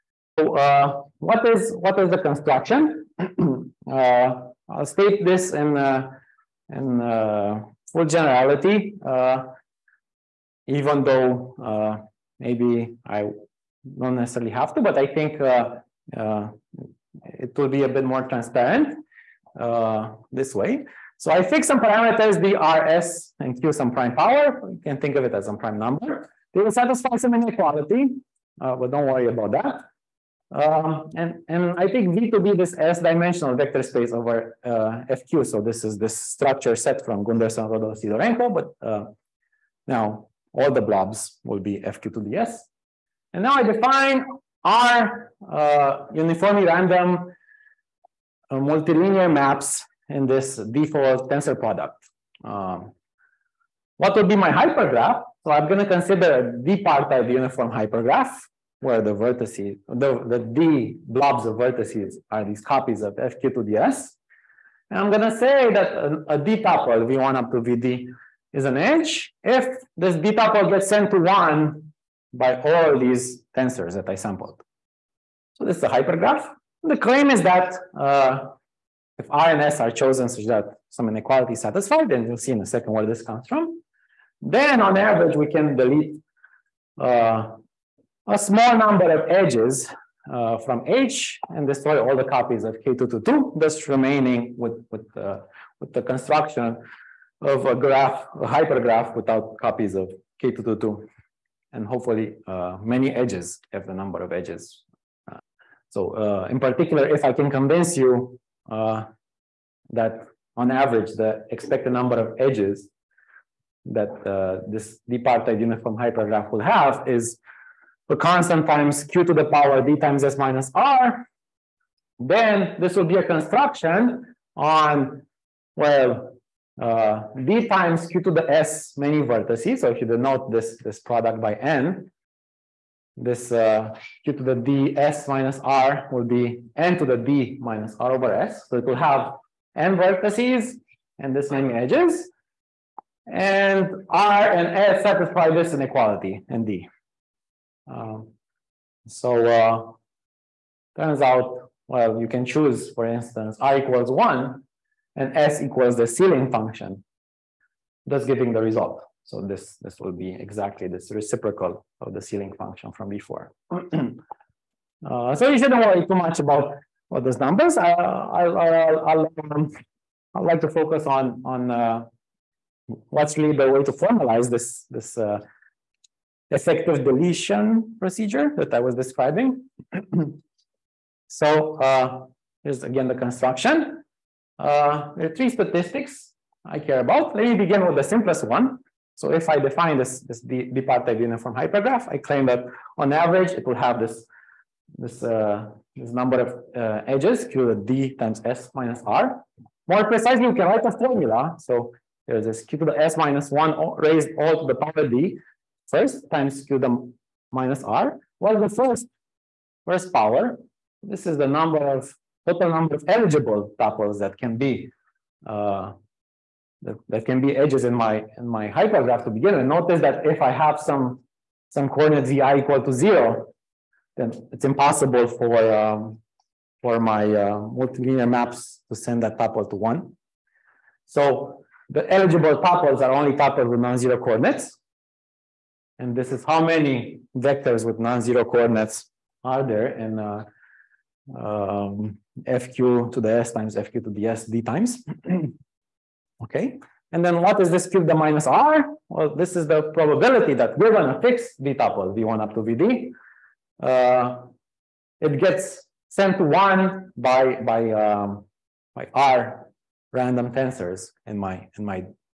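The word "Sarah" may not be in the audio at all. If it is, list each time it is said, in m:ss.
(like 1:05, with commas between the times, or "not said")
not said.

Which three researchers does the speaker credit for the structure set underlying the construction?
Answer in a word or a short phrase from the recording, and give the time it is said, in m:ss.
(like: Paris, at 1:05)
Gunderson, Rödl, Sidorenko, at 0:37.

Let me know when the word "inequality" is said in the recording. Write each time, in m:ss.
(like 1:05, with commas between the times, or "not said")
0:27, 1:21, 2:25.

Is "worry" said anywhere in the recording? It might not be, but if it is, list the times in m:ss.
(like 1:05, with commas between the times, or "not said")
0:29, 2:45.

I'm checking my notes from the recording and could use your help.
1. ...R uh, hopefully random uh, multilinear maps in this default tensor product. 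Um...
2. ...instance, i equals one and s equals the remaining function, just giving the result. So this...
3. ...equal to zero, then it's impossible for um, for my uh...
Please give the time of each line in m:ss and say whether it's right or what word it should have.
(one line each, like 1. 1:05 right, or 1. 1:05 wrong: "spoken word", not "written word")
1. 0:44 wrong: "uniformly", not "hopefully"
2. 2:33 wrong: "ceiling", not "remaining"
3. 3:42 right.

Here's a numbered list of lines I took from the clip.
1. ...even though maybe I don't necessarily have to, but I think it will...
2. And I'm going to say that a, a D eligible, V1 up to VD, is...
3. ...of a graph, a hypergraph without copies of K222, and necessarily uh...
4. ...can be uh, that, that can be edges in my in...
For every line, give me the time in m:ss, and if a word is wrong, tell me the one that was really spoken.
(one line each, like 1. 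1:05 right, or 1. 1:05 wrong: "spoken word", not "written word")
1. 0:10 right
2. 1:04 wrong: "tuple", not "eligible"
3. 1:37 wrong: "hopefully", not "necessarily"
4. 3:34 right.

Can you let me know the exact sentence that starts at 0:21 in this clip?
So I fix some parameters, RS and q some prime power.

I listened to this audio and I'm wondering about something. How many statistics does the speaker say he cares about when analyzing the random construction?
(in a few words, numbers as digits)
3.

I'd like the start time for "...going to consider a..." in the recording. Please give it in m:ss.
0:55.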